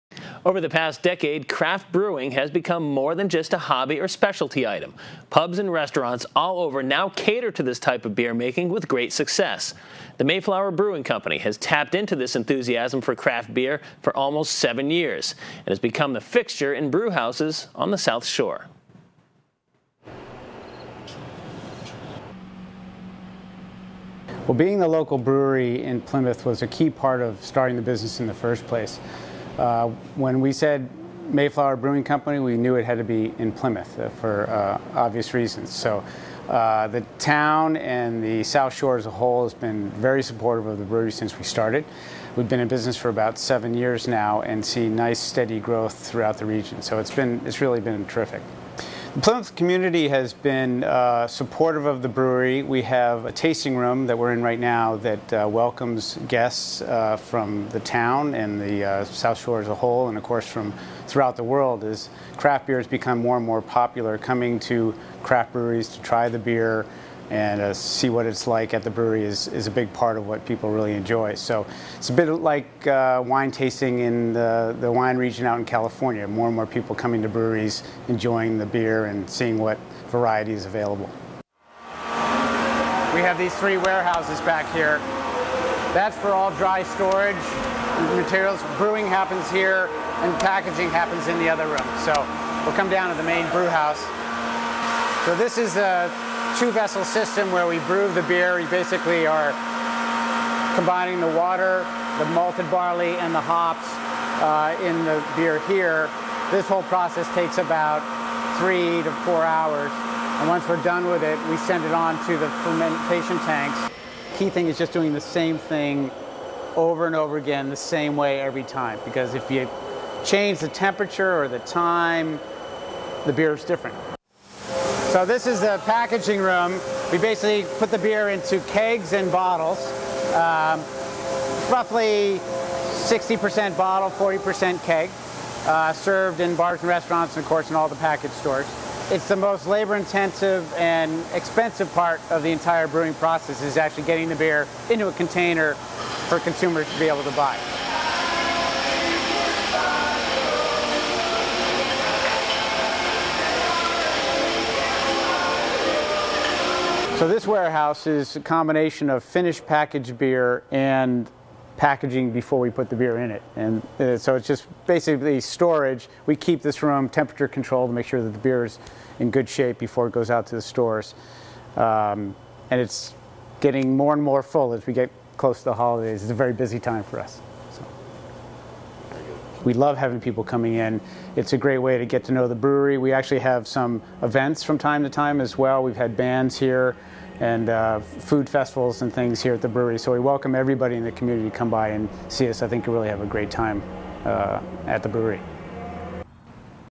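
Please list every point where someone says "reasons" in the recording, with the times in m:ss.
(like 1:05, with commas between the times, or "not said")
0:35.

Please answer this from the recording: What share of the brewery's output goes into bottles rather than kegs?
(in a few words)
60%.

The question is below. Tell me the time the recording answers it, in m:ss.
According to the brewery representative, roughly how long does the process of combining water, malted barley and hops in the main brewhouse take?
1:48.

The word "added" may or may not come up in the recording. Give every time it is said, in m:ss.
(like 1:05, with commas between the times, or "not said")
not said.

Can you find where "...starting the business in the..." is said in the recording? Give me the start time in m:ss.
0:27.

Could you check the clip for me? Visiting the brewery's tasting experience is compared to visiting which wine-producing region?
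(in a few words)
California.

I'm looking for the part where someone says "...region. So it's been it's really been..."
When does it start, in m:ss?
0:46.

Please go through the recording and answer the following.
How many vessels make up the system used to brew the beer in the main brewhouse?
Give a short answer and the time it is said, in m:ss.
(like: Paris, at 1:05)
2, at 1:36.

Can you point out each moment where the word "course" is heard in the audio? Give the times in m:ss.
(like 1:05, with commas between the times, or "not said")
1:00, 2:17.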